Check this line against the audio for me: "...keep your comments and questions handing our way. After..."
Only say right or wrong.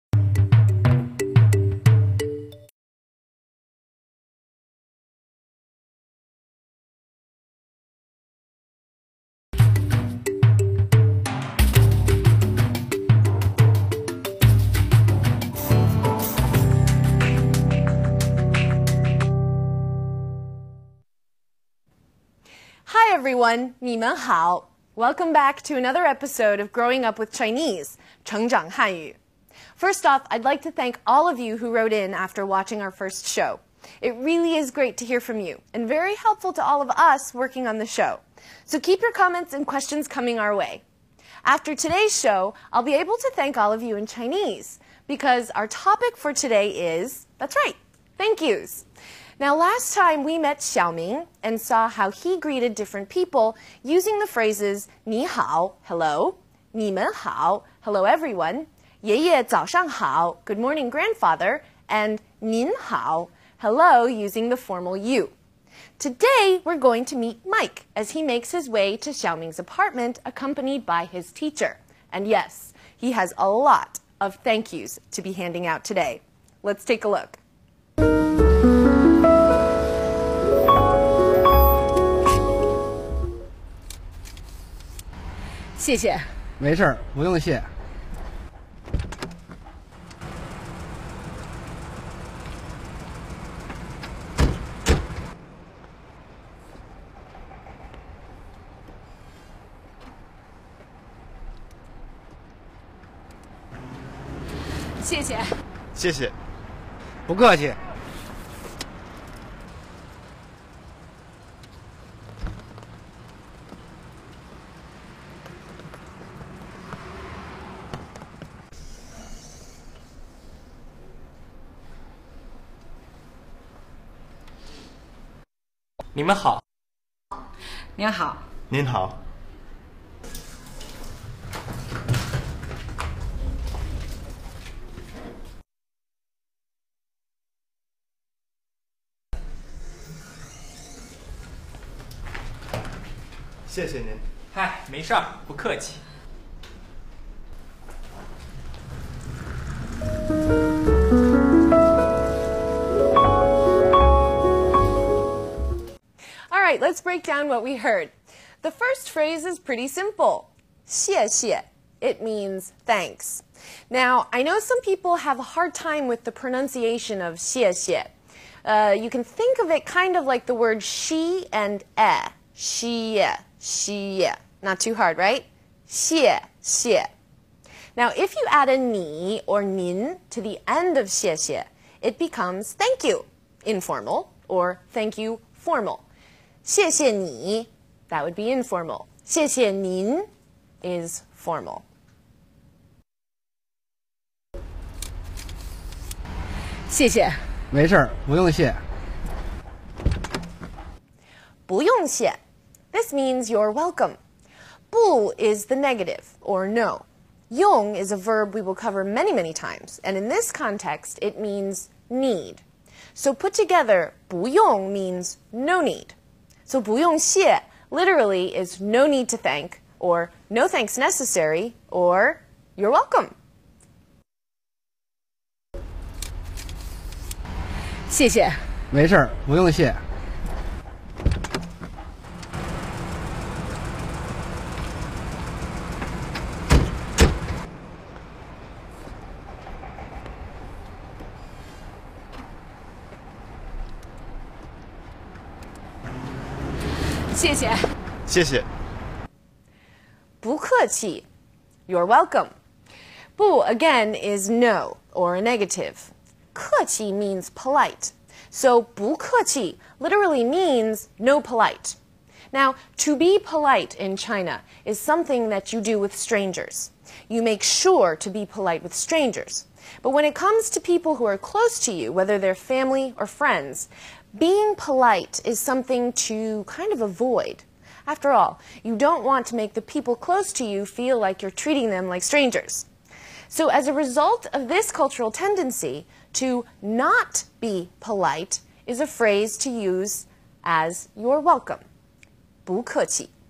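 wrong.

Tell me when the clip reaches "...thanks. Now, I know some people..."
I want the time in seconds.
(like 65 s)
162 s.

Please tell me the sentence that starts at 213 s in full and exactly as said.
So put together, 不 用 means no need.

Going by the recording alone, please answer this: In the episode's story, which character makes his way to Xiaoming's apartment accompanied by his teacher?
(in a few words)
Mike.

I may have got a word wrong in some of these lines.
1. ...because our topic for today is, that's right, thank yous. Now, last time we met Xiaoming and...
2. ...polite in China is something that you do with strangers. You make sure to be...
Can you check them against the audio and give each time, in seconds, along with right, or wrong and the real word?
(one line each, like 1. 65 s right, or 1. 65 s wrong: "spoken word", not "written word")
1. 45 s right
2. 263 s right.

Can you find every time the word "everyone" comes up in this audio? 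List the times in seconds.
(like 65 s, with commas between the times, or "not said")
23 s, 58 s.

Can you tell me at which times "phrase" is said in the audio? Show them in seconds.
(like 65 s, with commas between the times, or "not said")
54 s, 159 s, 289 s.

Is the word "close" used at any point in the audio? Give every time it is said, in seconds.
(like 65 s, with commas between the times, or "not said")
271 s, 280 s.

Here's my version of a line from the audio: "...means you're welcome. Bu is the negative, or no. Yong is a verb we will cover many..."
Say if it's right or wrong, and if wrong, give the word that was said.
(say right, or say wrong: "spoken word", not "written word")
right.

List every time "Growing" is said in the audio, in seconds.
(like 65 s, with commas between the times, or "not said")
26 s.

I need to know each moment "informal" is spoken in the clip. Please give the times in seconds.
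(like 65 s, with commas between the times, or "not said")
183 s, 188 s.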